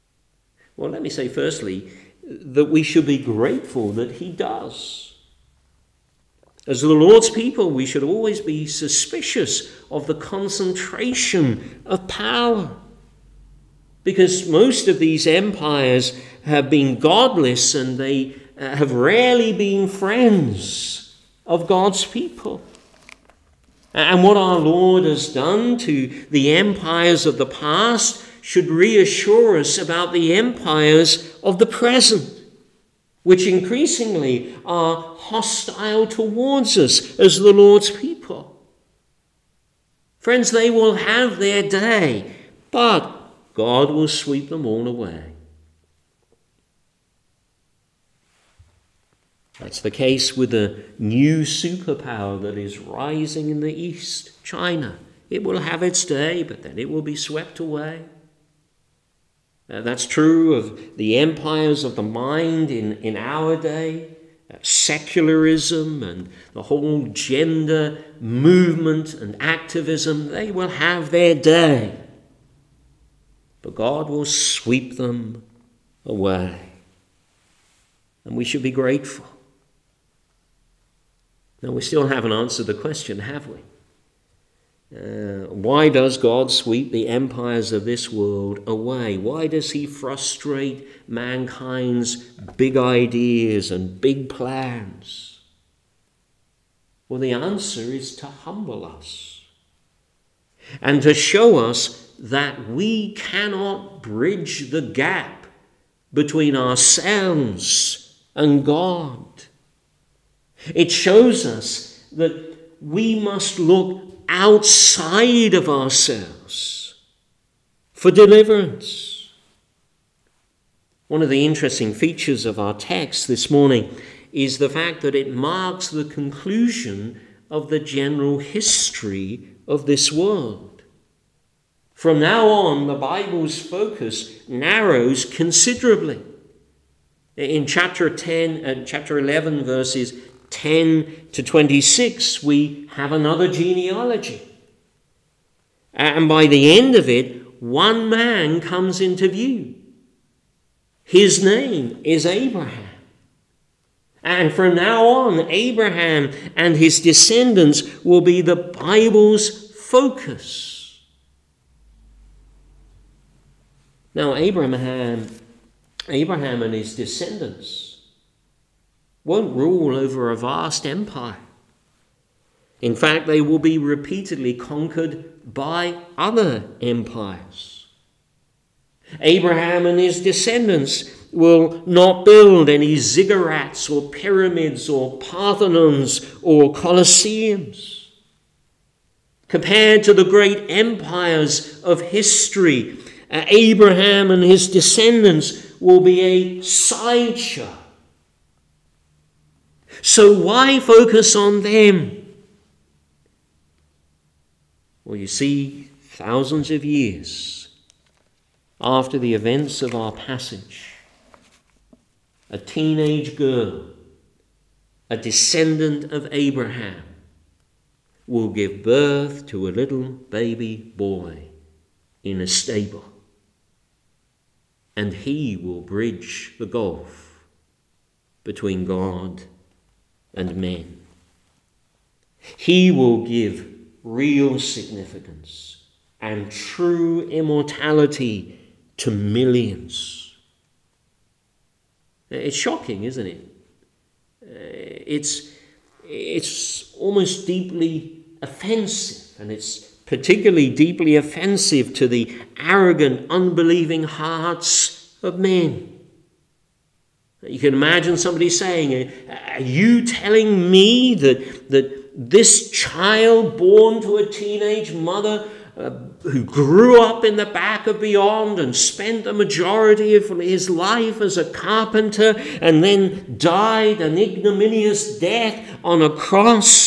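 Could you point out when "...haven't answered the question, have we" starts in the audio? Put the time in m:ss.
1:22.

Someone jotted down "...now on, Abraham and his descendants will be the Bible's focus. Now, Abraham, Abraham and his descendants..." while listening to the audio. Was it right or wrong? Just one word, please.
right.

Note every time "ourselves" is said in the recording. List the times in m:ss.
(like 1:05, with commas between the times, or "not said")
1:46, 1:55.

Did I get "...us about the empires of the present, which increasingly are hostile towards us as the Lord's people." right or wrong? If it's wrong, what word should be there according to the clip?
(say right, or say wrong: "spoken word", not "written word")
right.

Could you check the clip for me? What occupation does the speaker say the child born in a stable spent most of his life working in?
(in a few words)
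carpenter.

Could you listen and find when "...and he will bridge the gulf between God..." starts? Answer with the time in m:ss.
3:44.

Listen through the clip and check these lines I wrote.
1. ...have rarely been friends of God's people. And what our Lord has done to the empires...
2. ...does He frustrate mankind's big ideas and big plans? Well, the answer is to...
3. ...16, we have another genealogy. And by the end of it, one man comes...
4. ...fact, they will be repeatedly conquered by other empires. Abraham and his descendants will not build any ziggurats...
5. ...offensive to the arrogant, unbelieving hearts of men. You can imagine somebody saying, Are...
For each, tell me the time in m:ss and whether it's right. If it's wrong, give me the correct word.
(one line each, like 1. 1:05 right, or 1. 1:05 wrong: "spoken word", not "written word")
1. 0:18 right
2. 1:29 right
3. 2:21 wrong: "26", not "16"
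4. 2:52 right
5. 4:11 right.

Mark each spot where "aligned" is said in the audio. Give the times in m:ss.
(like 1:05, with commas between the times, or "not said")
not said.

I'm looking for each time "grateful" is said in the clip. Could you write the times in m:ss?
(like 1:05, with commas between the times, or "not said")
0:03, 1:18.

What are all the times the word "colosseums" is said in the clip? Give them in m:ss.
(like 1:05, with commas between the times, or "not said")
3:06.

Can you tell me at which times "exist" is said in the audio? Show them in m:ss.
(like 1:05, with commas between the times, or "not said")
not said.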